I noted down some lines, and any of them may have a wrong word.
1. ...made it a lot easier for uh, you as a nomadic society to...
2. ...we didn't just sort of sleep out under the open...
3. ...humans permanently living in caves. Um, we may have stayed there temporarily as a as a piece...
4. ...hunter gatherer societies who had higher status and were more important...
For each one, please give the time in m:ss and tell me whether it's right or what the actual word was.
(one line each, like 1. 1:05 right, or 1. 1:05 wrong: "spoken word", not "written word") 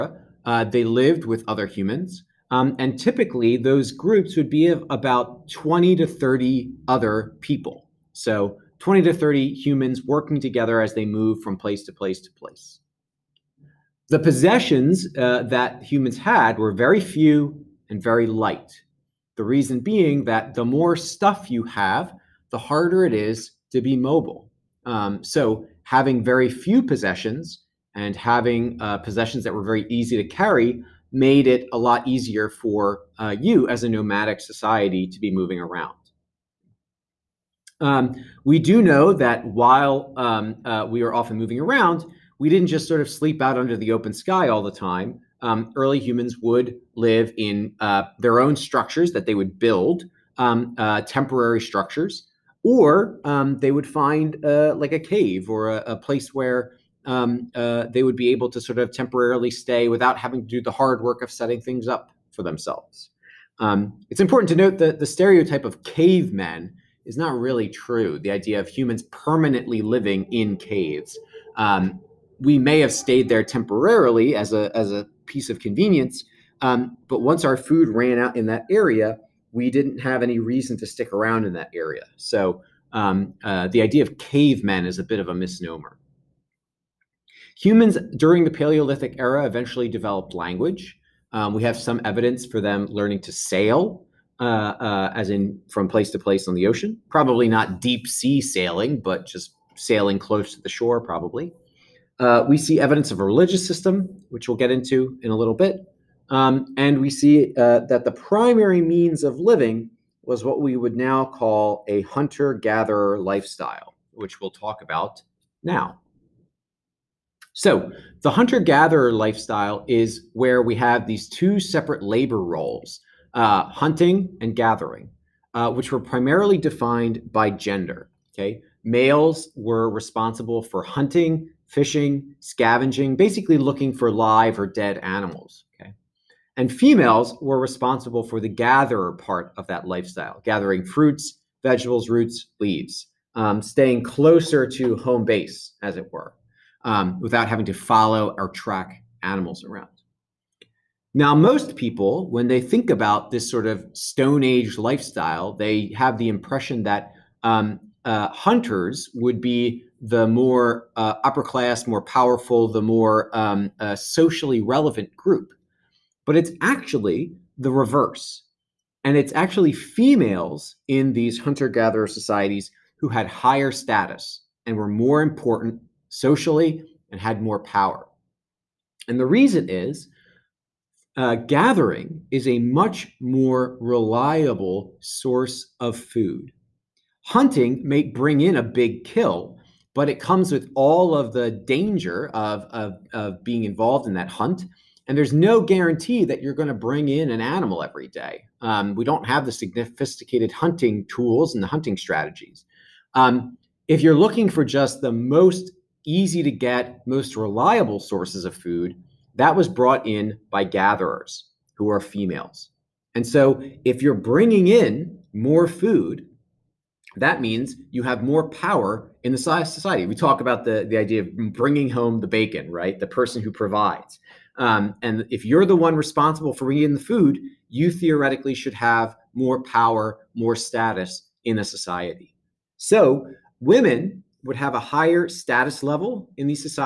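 1. 0:31 right
2. 0:42 right
3. 1:08 right
4. 2:51 right.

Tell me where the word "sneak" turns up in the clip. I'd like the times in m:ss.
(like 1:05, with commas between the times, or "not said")
not said.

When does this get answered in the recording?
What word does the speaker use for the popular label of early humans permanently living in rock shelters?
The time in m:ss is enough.
1:25.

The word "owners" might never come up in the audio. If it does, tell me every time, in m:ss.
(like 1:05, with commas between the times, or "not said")
not said.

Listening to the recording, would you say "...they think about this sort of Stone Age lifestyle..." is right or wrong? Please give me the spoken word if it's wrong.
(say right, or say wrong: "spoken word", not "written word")
right.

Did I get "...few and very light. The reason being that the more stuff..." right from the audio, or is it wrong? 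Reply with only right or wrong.
right.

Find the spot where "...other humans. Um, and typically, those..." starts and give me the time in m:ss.
0:01.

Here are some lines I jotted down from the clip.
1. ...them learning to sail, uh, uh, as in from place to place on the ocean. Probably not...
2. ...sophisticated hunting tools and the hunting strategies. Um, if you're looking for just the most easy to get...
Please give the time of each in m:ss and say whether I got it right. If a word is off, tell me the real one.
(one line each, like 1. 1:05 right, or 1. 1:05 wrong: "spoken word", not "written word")
1. 1:32 right
2. 3:19 right.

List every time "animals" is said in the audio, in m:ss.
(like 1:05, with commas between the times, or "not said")
2:14, 2:29, 3:17.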